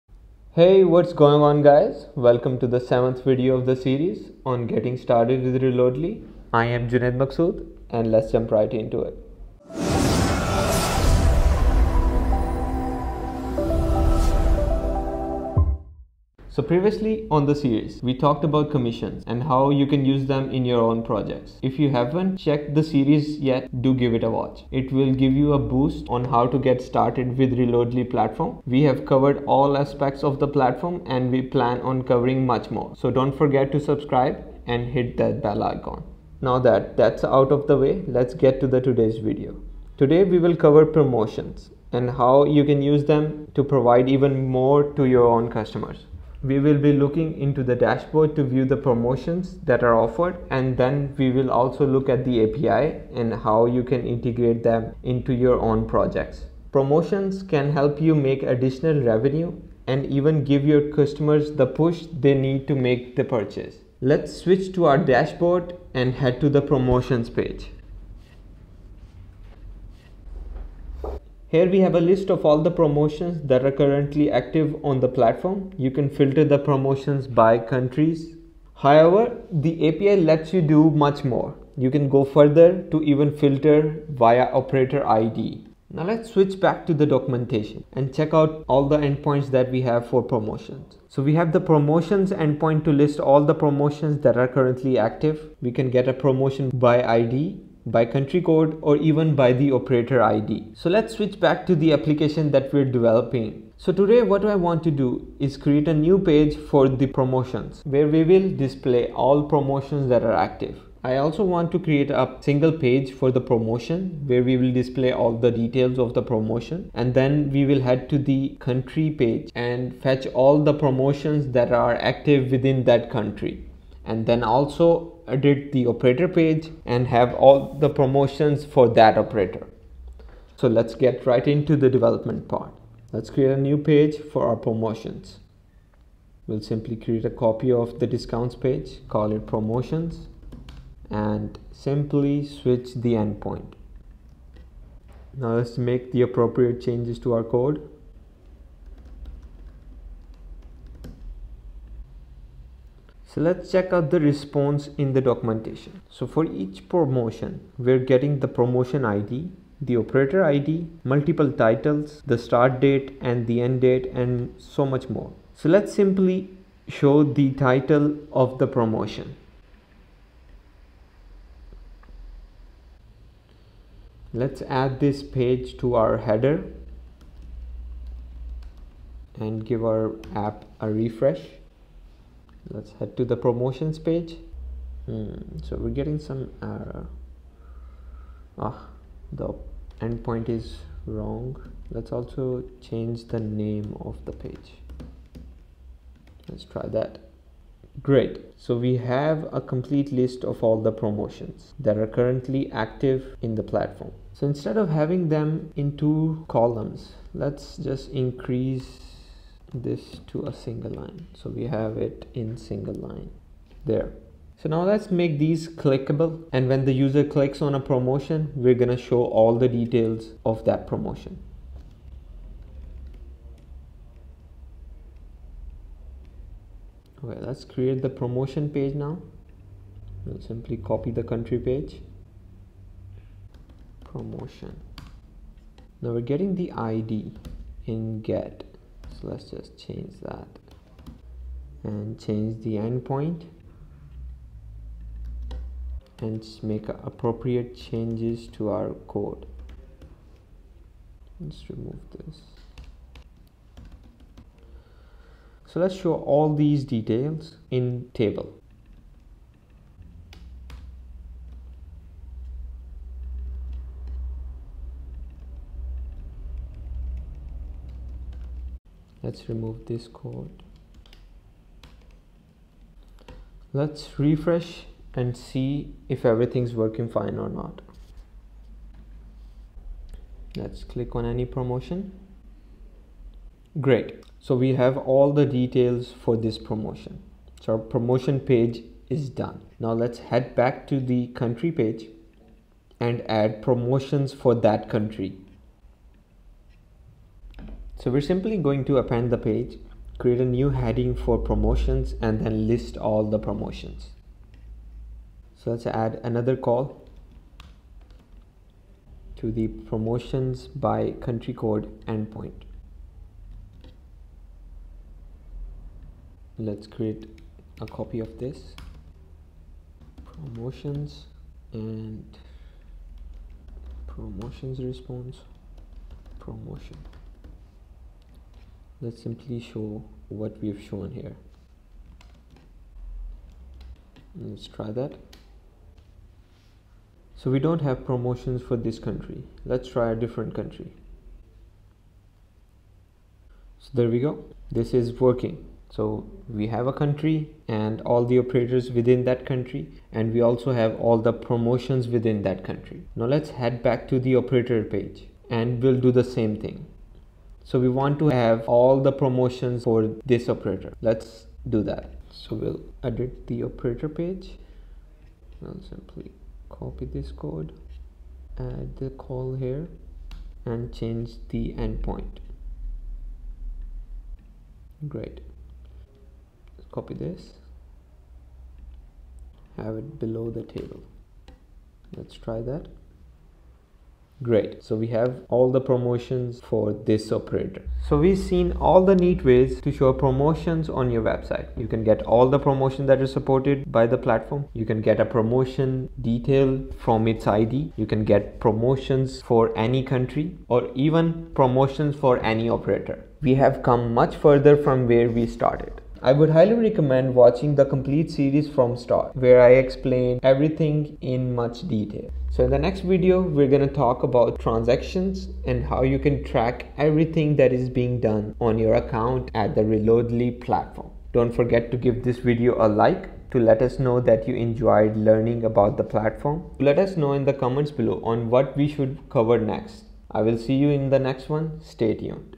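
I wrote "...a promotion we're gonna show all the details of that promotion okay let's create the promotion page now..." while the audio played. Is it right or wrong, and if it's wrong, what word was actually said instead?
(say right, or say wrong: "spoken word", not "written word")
right.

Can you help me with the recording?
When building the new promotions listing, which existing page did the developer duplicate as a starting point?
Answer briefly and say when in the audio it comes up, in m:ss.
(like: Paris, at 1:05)
discounts page, at 2:18.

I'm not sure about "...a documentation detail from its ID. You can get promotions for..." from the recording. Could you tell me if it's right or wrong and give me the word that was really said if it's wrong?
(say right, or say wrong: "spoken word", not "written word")
wrong: "promotion", not "documentation".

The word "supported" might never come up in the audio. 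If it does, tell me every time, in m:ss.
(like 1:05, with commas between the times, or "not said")
6:33.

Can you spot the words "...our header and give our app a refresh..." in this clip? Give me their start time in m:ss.
2:55.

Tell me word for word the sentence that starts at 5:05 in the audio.
So let's add another call to the promotions by country code endpoint.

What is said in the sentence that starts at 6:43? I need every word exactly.
We have come much further from where we started.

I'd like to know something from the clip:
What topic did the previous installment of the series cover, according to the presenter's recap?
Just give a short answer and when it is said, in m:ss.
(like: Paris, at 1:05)
commissions, at 0:18.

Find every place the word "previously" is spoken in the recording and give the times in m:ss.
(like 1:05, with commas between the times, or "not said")
0:16.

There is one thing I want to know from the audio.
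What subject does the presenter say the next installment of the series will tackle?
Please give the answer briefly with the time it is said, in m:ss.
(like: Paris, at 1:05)
transactions, at 6:54.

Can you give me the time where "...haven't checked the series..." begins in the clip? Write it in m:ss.
0:21.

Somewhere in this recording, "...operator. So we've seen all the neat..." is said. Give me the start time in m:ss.
6:27.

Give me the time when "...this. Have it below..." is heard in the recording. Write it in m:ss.
6:17.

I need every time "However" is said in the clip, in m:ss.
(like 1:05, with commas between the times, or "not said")
1:18.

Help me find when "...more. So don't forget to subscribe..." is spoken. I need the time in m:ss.
0:32.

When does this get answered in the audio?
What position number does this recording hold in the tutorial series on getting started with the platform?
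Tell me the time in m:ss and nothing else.
0:02.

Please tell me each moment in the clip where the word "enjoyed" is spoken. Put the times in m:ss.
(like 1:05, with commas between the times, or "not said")
7:04.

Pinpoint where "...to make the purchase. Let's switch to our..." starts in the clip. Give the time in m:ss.
1:02.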